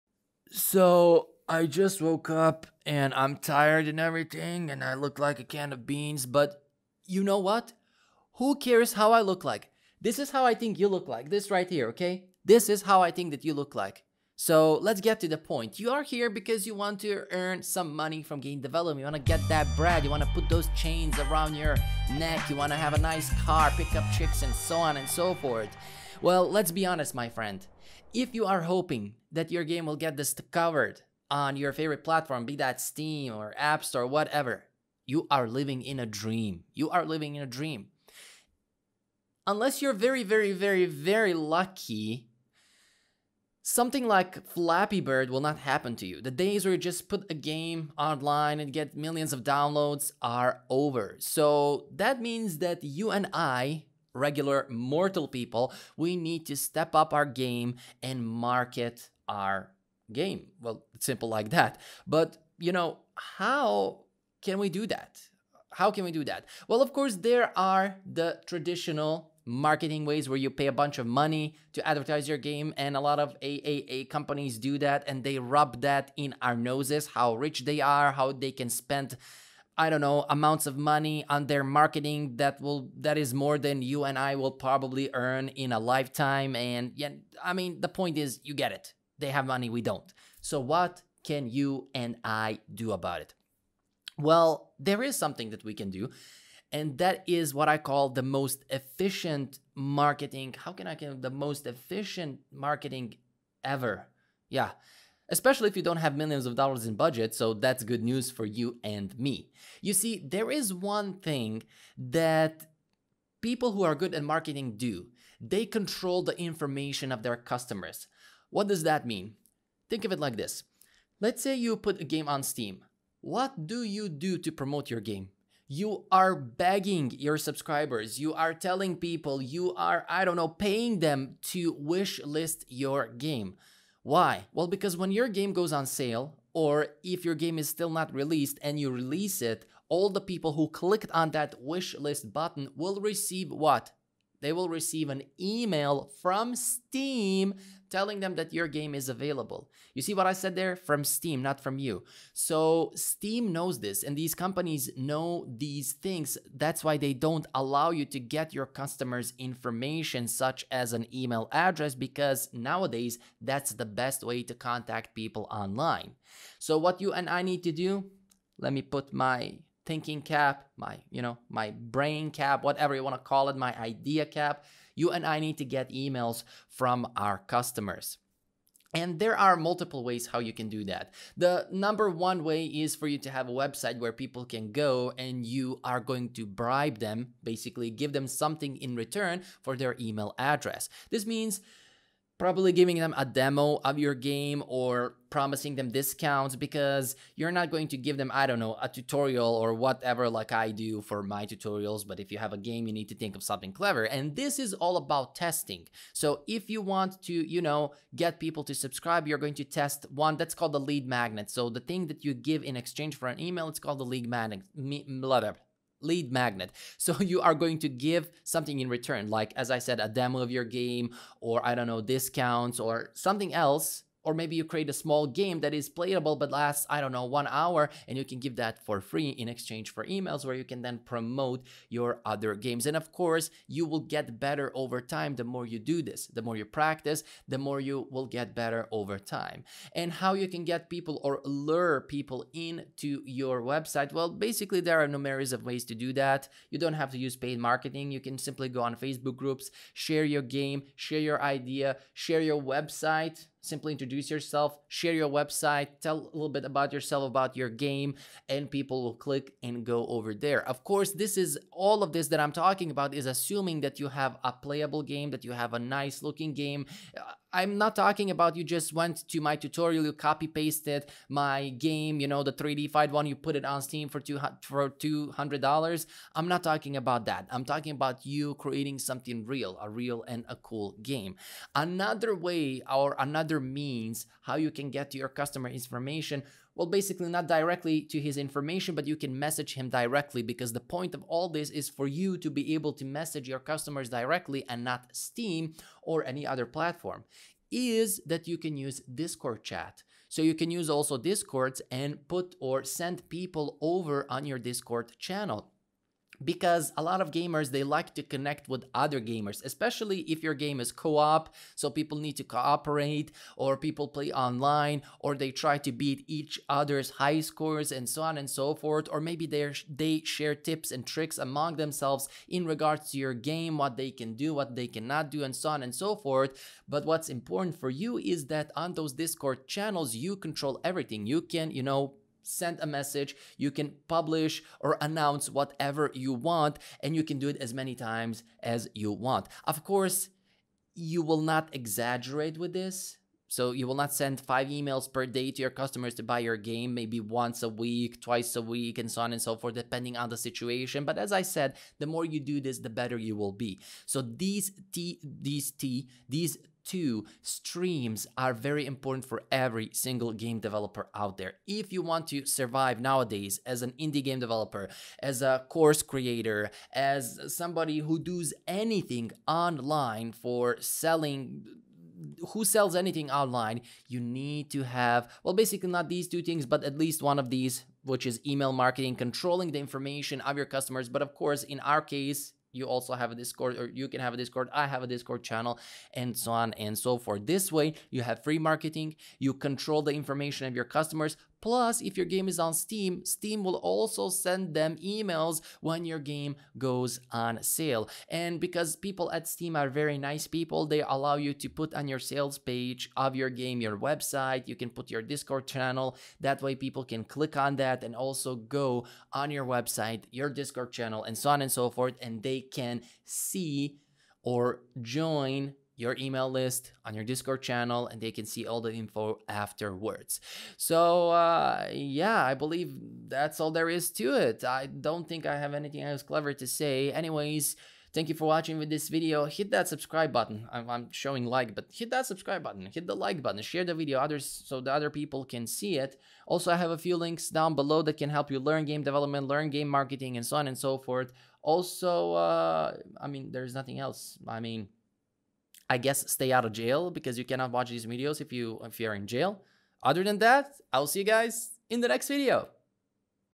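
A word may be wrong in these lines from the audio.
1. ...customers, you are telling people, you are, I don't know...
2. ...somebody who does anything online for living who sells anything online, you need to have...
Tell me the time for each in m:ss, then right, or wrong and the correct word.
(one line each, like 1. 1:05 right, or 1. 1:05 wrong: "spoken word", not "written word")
1. 2:07 wrong: "subscribers", not "customers"
2. 6:07 wrong: "selling", not "living".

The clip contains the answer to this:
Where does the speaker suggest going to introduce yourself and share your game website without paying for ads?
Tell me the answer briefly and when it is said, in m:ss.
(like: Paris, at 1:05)
Facebook groups, at 4:08.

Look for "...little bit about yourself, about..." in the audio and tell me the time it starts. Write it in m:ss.
4:16.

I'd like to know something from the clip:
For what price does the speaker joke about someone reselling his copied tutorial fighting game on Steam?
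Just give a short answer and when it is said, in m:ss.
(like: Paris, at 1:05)
$200, at 4:34.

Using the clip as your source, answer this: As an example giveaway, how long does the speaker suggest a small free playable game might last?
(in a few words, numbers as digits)
one hour.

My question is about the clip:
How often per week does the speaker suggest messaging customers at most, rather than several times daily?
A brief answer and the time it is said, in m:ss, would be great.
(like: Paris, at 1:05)
twice a week, at 5:48.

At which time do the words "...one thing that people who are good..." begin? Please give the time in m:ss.
1:50.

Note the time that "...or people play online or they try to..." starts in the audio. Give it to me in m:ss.
5:13.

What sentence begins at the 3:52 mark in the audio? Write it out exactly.
And of course, you will get better over time the more you do this.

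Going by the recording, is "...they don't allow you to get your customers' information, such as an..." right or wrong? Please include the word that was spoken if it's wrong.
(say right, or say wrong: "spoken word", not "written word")
right.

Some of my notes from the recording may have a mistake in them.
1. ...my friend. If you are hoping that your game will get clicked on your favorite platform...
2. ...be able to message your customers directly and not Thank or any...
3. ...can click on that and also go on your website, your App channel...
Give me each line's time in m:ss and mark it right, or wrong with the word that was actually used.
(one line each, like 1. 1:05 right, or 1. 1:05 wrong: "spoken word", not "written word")
1. 0:27 wrong: "discovered", not "clicked"
2. 4:52 wrong: "Steam", not "Thank"
3. 6:47 wrong: "Discord", not "App".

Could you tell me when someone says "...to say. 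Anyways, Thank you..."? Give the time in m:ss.
7:06.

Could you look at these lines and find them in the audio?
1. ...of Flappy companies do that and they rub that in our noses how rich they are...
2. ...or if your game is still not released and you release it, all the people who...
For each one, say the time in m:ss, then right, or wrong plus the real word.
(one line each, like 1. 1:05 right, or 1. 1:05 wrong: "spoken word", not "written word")
1. 1:13 wrong: "AAA", not "Flappy"
2. 2:16 right.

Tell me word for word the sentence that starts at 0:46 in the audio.
The days where you just put a game online and get millions of downloads are over.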